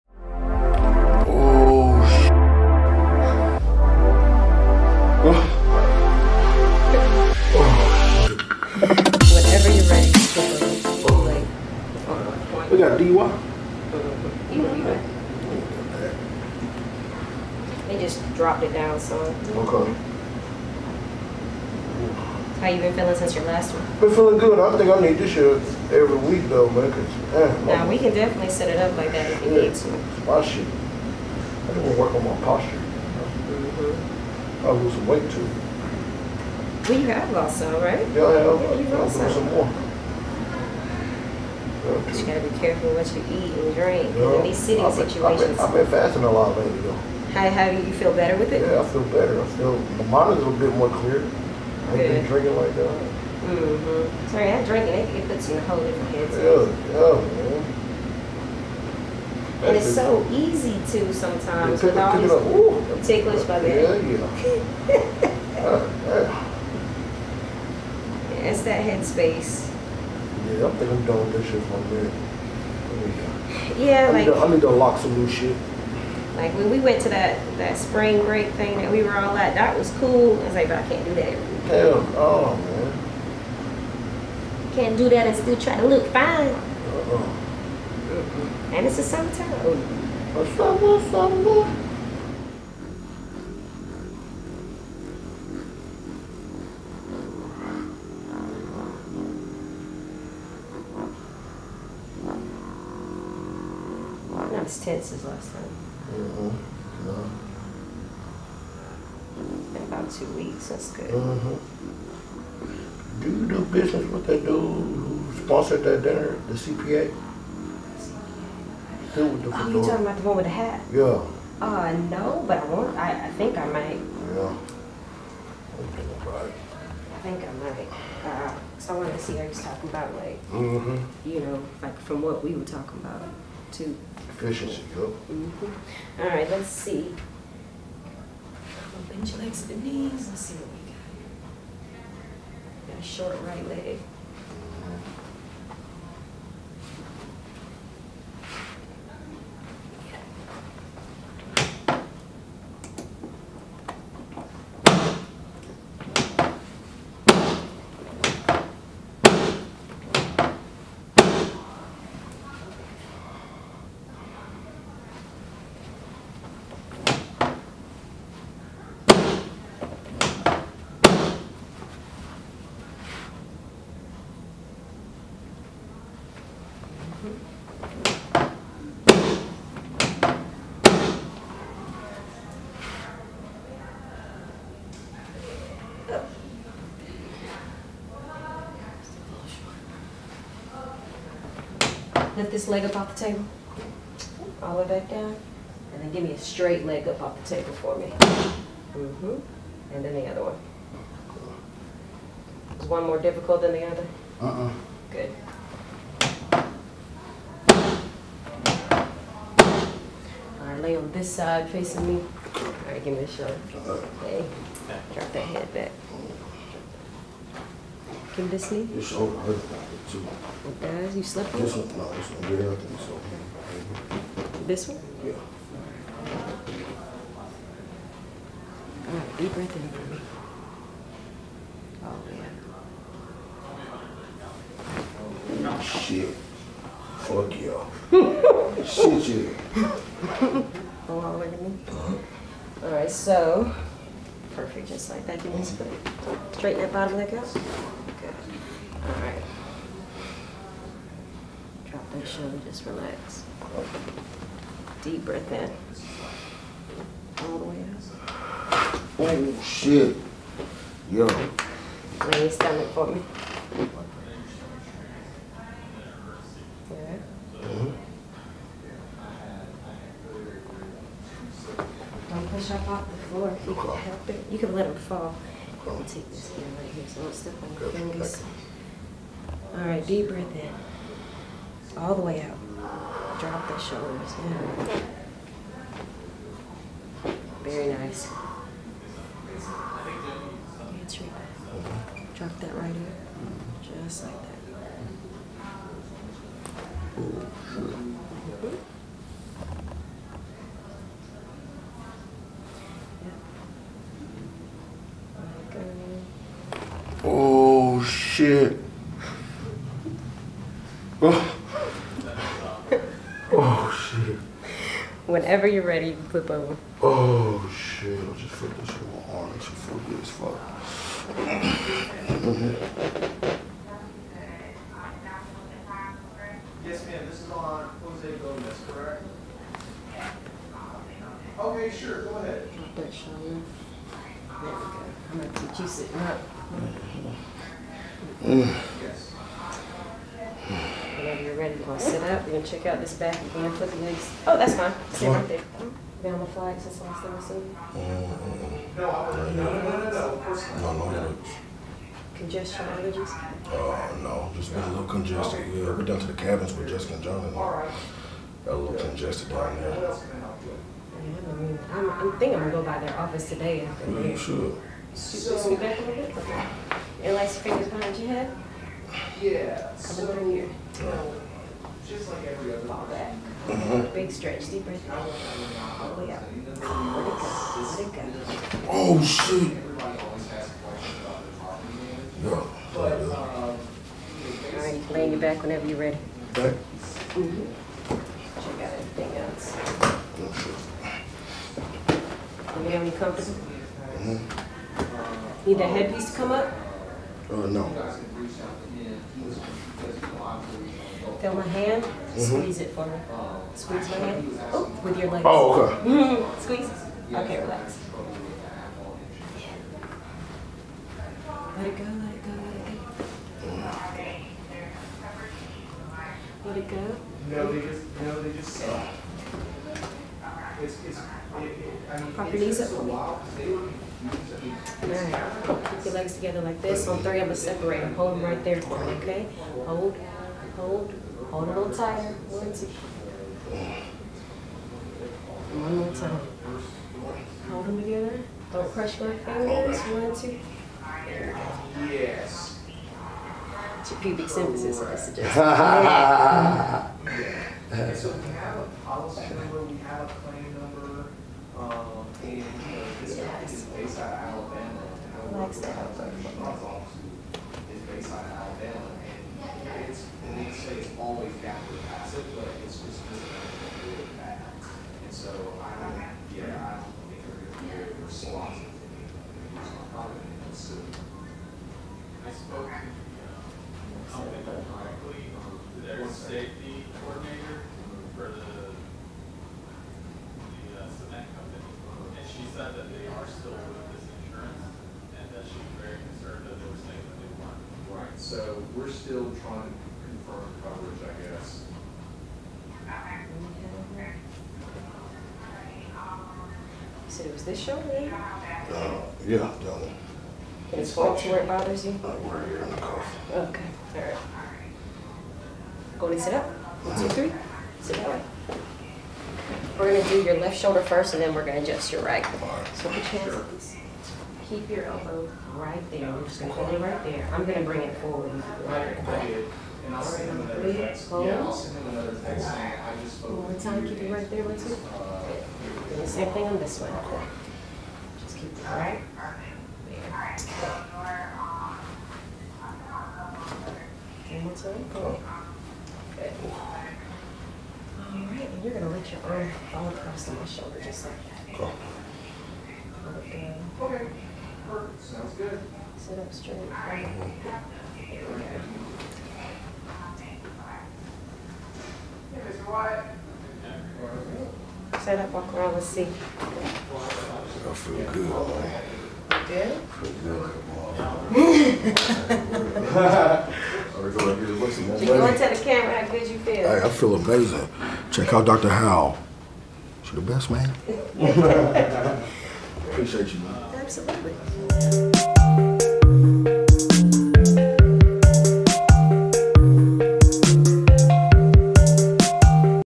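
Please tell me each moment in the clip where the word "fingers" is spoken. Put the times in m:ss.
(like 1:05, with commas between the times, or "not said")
4:37, 6:07, 7:19.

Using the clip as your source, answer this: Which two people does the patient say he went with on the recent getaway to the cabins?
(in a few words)
Jessica and John.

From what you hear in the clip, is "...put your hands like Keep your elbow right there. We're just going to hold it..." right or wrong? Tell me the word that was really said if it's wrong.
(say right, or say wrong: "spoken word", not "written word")
right.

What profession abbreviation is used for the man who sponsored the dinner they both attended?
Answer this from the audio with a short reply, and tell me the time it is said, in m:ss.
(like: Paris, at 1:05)
CPA, at 1:56.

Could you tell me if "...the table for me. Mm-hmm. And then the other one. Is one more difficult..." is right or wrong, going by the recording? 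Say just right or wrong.
right.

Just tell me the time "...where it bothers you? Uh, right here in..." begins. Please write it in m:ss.
8:21.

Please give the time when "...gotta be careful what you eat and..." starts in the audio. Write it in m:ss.
0:42.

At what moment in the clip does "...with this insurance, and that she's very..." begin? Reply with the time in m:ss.
8:03.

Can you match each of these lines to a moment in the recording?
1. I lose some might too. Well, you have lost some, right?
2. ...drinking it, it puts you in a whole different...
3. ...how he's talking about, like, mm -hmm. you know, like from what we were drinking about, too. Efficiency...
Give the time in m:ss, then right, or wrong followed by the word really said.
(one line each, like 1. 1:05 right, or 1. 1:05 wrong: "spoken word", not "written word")
1. 0:34 wrong: "weight", not "might"
2. 0:54 right
3. 2:09 wrong: "talking", not "drinking".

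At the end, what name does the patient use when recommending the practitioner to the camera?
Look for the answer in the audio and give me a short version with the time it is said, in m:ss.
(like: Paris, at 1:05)
Dr. Howell, at 9:28.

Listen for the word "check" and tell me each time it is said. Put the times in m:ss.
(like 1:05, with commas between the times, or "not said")
5:42, 6:28, 9:28.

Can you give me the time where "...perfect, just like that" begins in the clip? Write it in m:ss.
4:04.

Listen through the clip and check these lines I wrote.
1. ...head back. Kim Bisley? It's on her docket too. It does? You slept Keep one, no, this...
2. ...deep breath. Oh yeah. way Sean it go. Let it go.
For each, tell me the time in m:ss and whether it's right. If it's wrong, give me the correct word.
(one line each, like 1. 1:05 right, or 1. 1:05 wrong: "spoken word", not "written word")
1. 3:35 wrong: "This", not "Keep"
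2. 6:14 wrong: "Let", not "Sean".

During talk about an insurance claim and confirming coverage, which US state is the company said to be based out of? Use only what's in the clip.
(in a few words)
Alabama.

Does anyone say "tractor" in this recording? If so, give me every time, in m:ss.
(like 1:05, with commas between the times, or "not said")
not said.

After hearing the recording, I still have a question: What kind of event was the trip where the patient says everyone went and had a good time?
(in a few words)
spring break.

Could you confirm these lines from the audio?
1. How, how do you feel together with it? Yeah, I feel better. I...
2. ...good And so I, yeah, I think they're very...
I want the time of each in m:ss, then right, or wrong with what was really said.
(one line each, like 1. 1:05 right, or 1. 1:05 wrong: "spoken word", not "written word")
1. 0:47 wrong: "better", not "together"
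2. 7:43 right.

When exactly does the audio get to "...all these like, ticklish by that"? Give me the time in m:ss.
1:01.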